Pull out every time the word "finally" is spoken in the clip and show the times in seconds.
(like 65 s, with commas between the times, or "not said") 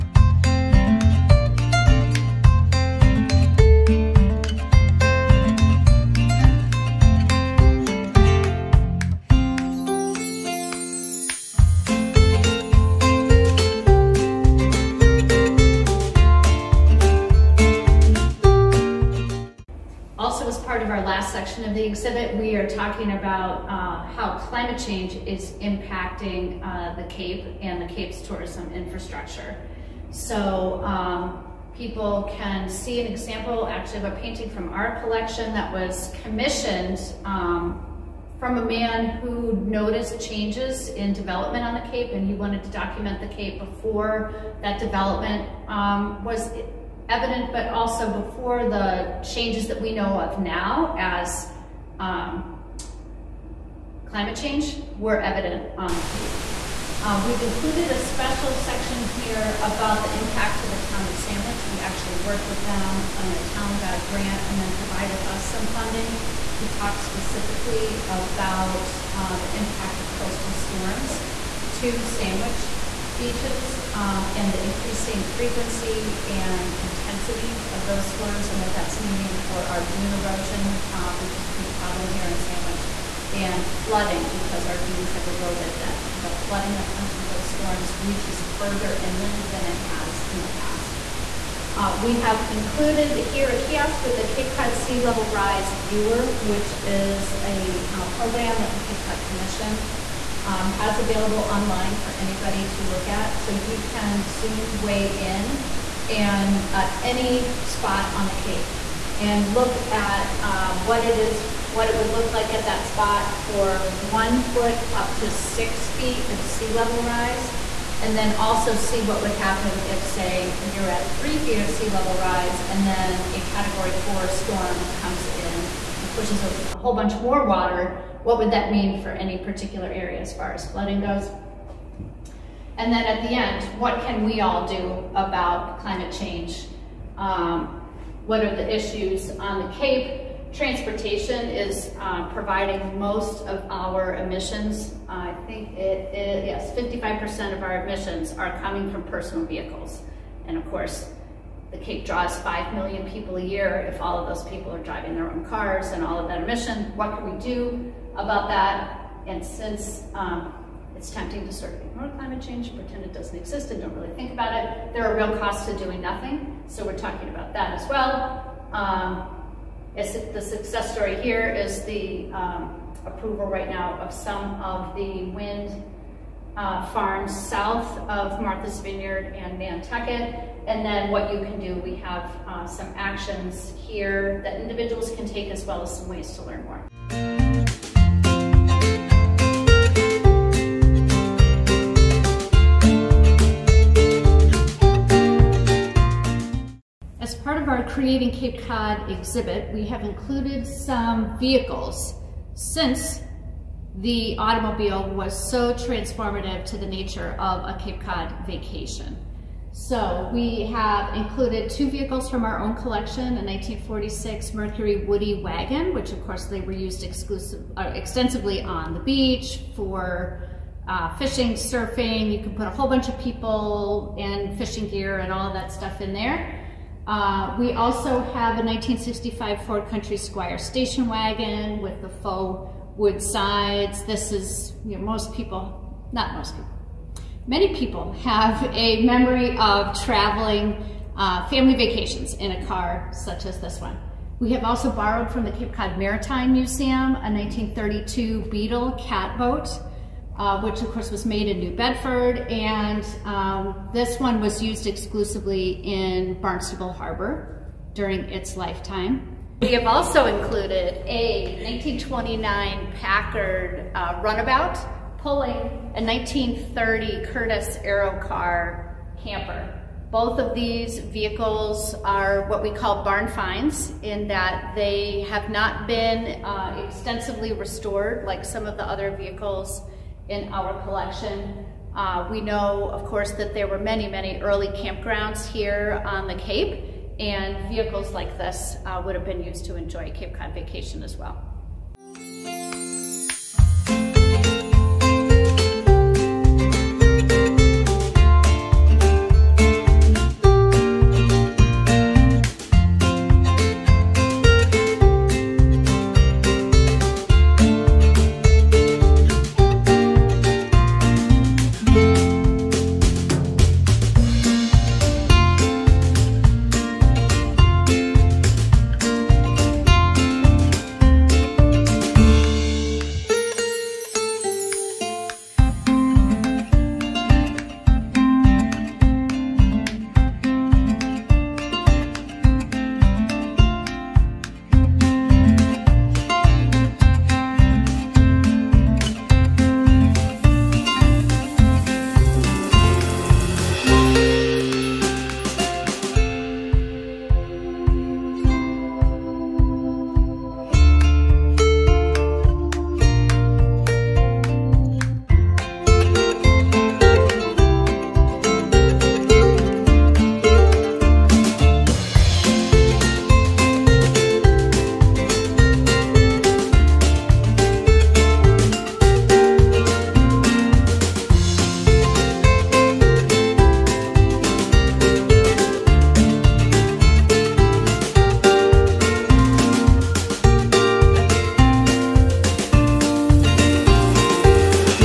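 not said.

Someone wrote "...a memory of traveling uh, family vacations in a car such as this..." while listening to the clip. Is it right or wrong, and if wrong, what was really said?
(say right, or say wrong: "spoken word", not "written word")
right.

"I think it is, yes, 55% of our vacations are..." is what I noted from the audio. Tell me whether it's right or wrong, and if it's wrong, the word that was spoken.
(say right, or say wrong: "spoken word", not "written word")
wrong: "emissions", not "vacations".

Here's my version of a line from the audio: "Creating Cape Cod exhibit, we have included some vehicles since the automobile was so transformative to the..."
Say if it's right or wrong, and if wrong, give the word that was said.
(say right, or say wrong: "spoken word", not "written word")
right.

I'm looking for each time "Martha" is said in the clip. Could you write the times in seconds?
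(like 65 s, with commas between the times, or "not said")
178 s.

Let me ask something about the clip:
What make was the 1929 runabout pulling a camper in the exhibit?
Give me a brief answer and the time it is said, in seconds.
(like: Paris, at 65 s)
Packard, at 262 s.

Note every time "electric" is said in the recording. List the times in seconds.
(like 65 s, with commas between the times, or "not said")
not said.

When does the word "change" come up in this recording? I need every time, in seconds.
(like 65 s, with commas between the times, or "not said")
24 s, 40 s, 49 s, 54 s, 136 s, 162 s.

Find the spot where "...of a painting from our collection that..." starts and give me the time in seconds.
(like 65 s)
33 s.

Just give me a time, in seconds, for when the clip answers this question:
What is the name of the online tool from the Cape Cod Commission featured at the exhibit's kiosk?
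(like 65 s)
94 s.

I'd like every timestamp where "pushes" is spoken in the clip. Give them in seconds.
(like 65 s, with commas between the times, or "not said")
126 s.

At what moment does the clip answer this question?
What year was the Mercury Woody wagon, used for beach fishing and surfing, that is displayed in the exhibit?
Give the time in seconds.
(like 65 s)
213 s.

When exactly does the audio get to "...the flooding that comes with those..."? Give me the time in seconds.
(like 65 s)
86 s.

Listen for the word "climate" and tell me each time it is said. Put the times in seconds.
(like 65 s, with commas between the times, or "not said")
24 s, 54 s, 135 s, 162 s.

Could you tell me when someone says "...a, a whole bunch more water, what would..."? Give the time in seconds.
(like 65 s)
126 s.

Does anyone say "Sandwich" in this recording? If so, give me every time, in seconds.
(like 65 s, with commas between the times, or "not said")
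61 s, 72 s, 82 s.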